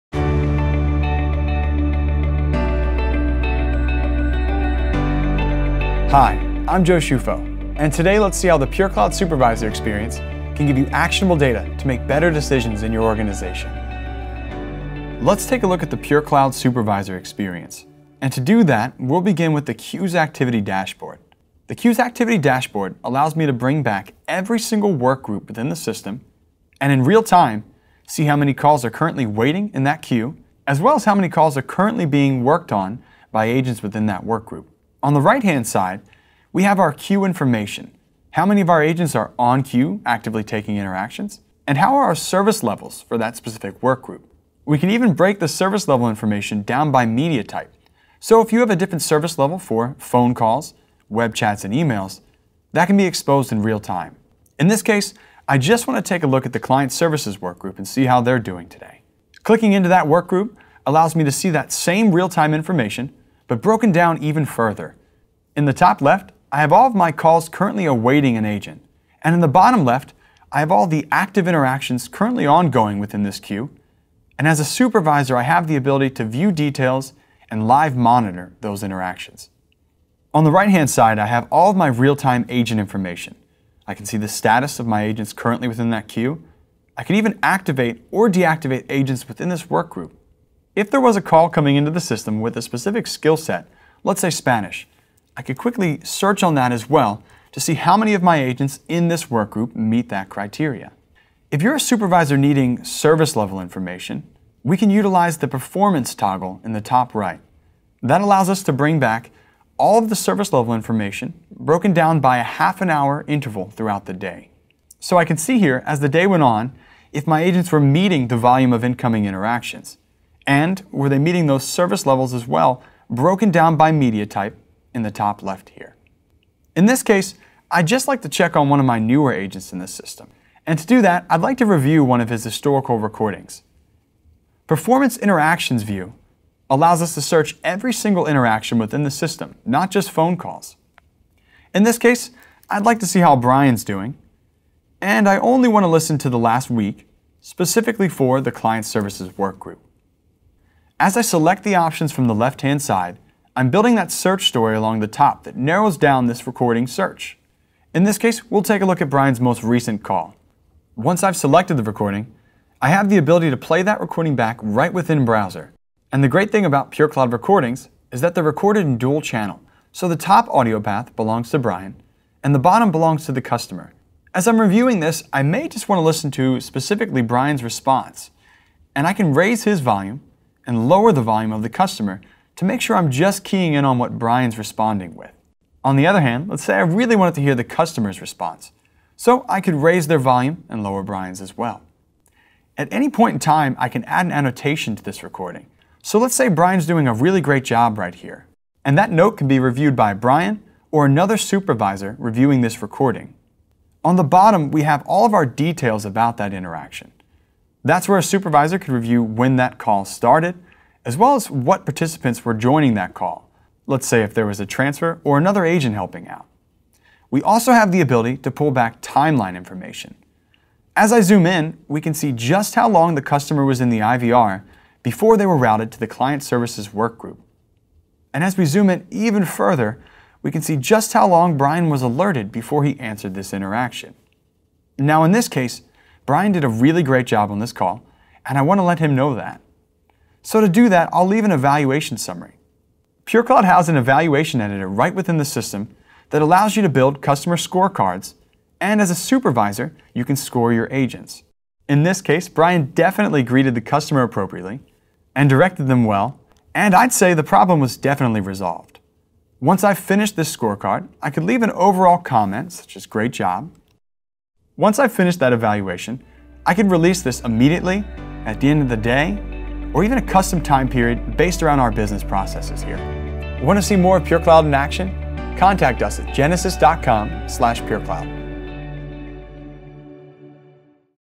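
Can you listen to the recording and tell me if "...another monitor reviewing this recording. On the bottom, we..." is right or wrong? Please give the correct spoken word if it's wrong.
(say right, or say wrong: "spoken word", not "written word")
wrong: "supervisor", not "monitor".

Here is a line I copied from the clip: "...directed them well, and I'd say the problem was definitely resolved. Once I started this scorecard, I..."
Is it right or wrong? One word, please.
wrong.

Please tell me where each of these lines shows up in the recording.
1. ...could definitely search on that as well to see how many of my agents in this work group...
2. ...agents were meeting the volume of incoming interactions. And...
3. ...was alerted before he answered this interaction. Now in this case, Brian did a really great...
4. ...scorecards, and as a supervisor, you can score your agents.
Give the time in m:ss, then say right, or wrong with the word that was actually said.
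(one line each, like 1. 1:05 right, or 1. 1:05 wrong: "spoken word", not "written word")
1. 1:35 wrong: "quickly", not "definitely"
2. 1:57 right
3. 3:51 right
4. 4:07 right.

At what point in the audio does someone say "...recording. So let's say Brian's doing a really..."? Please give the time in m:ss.
3:15.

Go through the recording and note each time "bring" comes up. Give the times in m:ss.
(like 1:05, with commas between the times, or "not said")
0:23, 1:48.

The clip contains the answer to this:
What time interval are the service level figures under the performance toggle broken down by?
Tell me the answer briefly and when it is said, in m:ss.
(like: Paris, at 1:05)
Half an hour, at 1:52.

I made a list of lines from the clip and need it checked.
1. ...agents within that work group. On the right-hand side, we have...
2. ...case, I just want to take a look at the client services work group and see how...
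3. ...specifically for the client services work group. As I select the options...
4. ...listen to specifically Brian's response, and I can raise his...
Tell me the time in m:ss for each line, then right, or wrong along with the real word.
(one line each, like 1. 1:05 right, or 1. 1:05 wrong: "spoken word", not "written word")
1. 0:33 right
2. 0:54 right
3. 2:27 right
4. 2:56 right.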